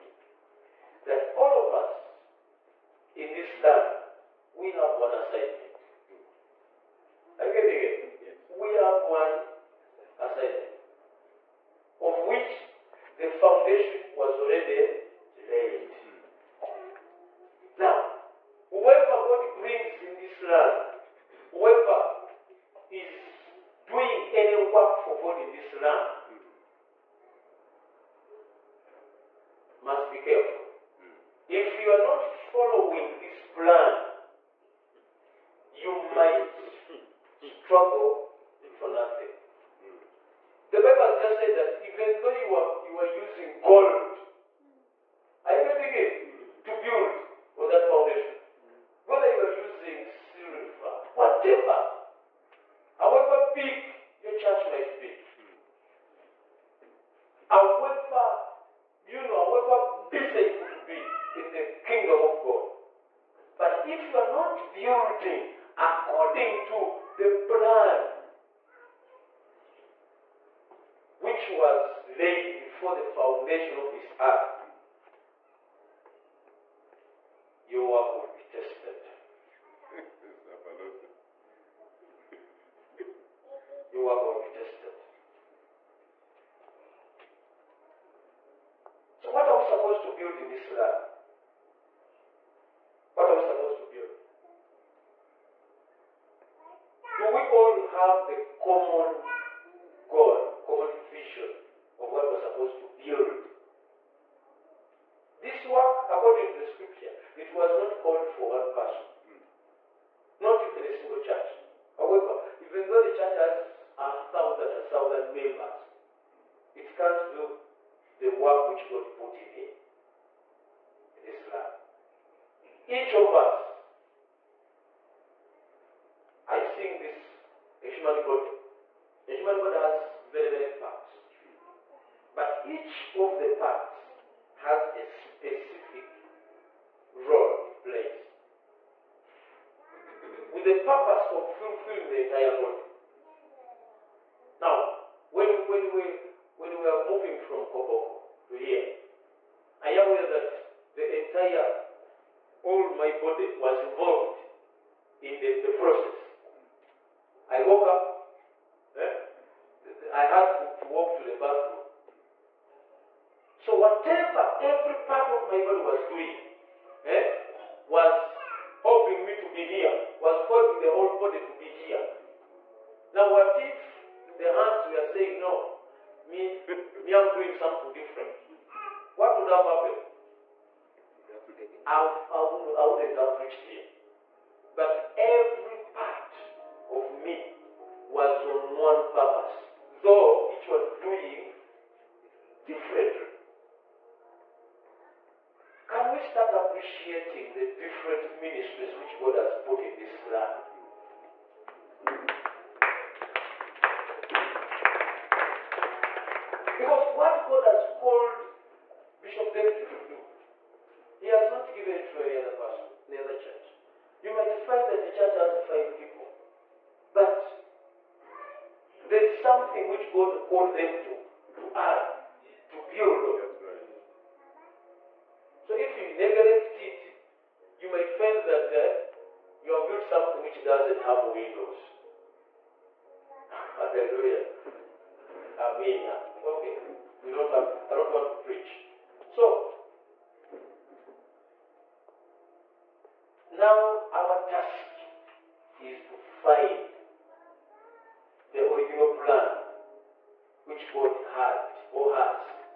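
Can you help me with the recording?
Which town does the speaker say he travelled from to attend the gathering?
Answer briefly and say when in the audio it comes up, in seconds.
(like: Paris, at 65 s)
Koboko, at 147 s.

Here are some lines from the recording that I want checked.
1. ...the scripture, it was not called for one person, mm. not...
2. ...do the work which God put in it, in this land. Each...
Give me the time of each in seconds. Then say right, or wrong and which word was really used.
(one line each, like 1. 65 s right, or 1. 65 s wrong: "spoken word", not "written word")
1. 106 s right
2. 117 s right.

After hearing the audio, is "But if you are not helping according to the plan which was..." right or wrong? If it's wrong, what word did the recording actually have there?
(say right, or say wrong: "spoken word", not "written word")
wrong: "building", not "helping".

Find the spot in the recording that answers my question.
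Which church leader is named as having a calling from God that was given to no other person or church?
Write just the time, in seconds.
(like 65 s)
209 s.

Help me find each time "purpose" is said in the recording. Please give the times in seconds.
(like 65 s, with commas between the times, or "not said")
140 s, 189 s.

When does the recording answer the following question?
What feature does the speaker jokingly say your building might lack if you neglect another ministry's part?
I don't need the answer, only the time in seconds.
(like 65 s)
231 s.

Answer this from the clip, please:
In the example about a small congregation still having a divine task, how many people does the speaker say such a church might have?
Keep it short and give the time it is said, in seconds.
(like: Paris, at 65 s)
5, at 215 s.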